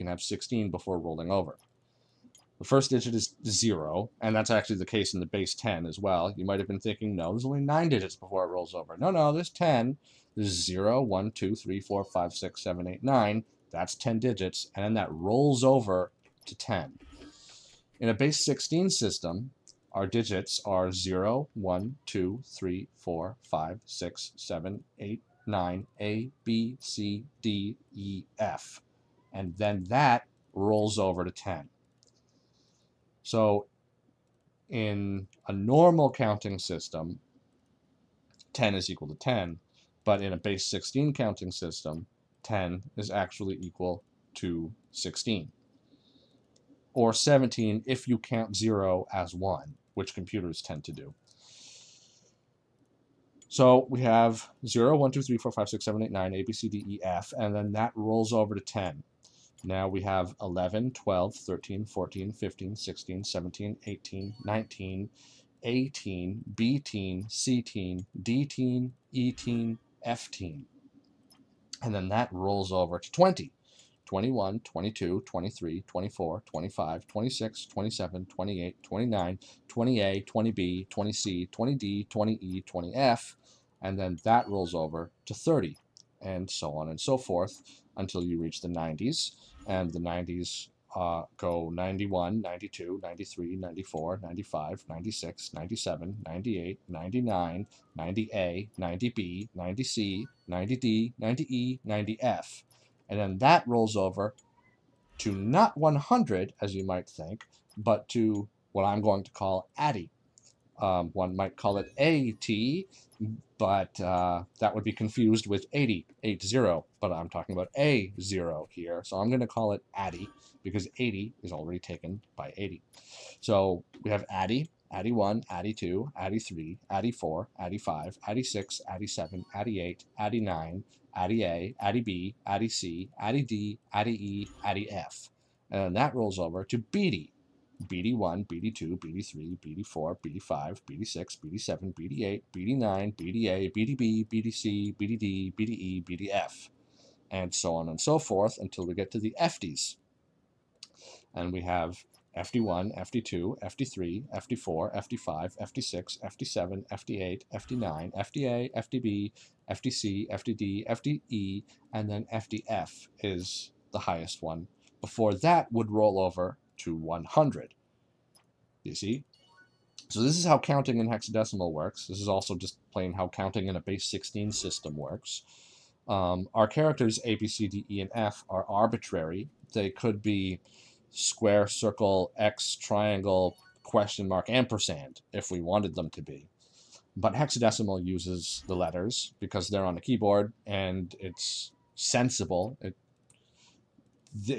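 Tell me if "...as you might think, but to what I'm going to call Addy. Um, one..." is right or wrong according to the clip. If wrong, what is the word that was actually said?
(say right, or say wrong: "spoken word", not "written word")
right.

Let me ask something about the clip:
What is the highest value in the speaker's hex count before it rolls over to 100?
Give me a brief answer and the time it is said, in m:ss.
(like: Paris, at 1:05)
FDF, at 2:42.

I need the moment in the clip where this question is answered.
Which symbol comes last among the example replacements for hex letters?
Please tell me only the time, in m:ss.
3:04.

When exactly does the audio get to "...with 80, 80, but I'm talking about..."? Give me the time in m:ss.
1:55.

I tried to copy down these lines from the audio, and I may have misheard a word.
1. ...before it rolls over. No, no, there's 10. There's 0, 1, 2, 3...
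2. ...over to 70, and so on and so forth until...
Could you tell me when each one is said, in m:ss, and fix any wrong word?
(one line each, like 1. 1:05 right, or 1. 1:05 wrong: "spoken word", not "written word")
1. 0:08 right
2. 1:24 wrong: "30", not "70".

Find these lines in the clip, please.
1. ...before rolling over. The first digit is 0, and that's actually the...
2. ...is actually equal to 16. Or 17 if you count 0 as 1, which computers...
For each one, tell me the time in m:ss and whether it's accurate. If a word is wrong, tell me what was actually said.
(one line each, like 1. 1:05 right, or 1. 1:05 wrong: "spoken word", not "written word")
1. 0:00 right
2. 0:42 right.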